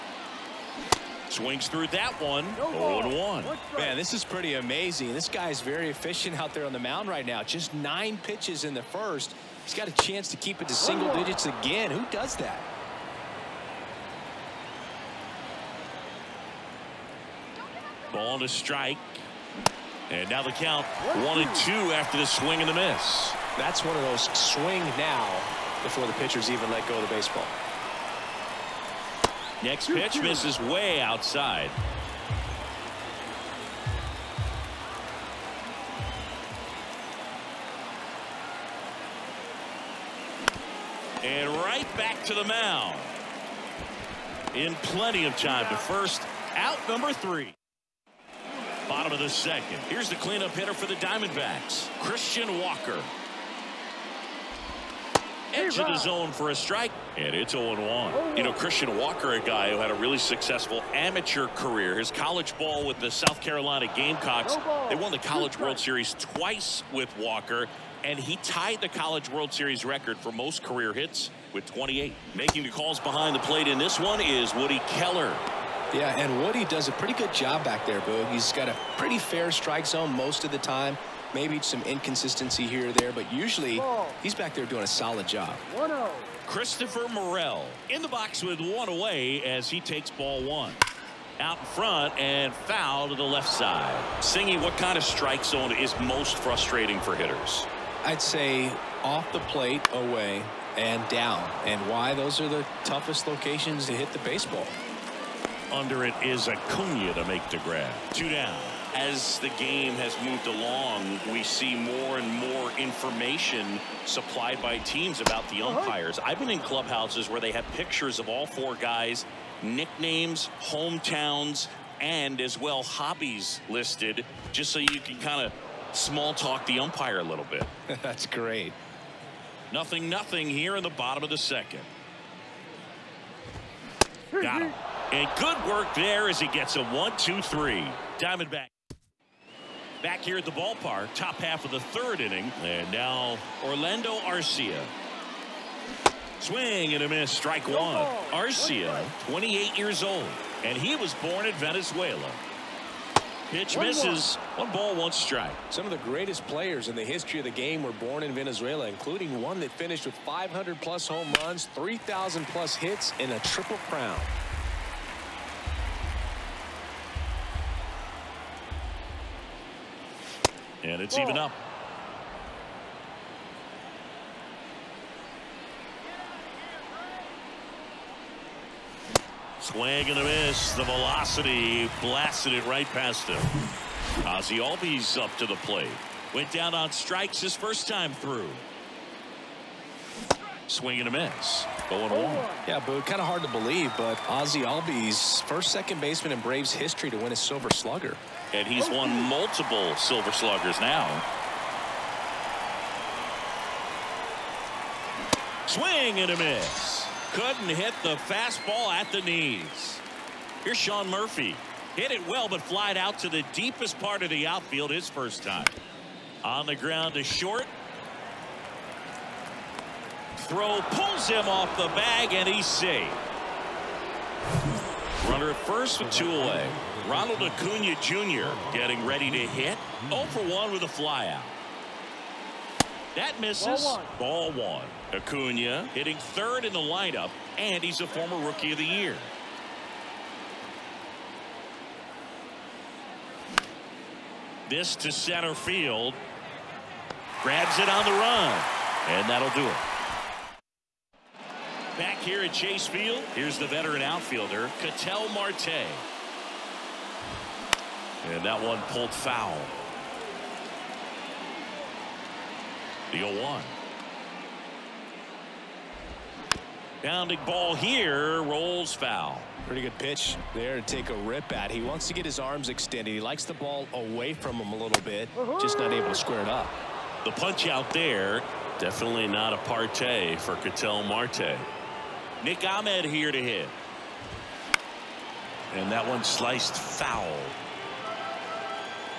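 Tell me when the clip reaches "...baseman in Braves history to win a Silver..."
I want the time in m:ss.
3:16.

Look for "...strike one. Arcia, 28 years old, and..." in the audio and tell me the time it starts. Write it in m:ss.
2:27.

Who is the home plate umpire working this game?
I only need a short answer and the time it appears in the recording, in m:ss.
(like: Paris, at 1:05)
Woody Keller, at 1:14.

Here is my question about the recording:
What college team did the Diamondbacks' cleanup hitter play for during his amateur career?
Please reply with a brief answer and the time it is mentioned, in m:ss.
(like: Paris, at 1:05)
South Carolina Gamecocks, at 1:03.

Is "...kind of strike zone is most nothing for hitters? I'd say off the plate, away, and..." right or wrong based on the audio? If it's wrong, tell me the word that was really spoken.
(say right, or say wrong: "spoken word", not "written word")
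wrong: "frustrating", not "nothing".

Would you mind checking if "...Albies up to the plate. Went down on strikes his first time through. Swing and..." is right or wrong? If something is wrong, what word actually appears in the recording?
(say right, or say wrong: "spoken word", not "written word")
right.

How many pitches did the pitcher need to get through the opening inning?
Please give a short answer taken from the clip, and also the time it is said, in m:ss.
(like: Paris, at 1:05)
9, at 0:07.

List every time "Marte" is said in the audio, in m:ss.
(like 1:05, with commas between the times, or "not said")
4:15, 4:41.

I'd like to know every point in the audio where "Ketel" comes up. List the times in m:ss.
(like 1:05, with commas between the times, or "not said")
4:14, 4:40.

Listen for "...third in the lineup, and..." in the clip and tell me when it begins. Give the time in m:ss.
3:56.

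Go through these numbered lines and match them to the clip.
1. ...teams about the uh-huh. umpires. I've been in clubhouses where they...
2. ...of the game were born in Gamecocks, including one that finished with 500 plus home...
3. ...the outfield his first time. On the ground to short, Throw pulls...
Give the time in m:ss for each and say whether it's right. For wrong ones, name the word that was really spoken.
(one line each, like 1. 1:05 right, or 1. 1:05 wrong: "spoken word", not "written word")
1. 1:54 right
2. 2:37 wrong: "Venezuela", not "Gamecocks"
3. 3:34 right.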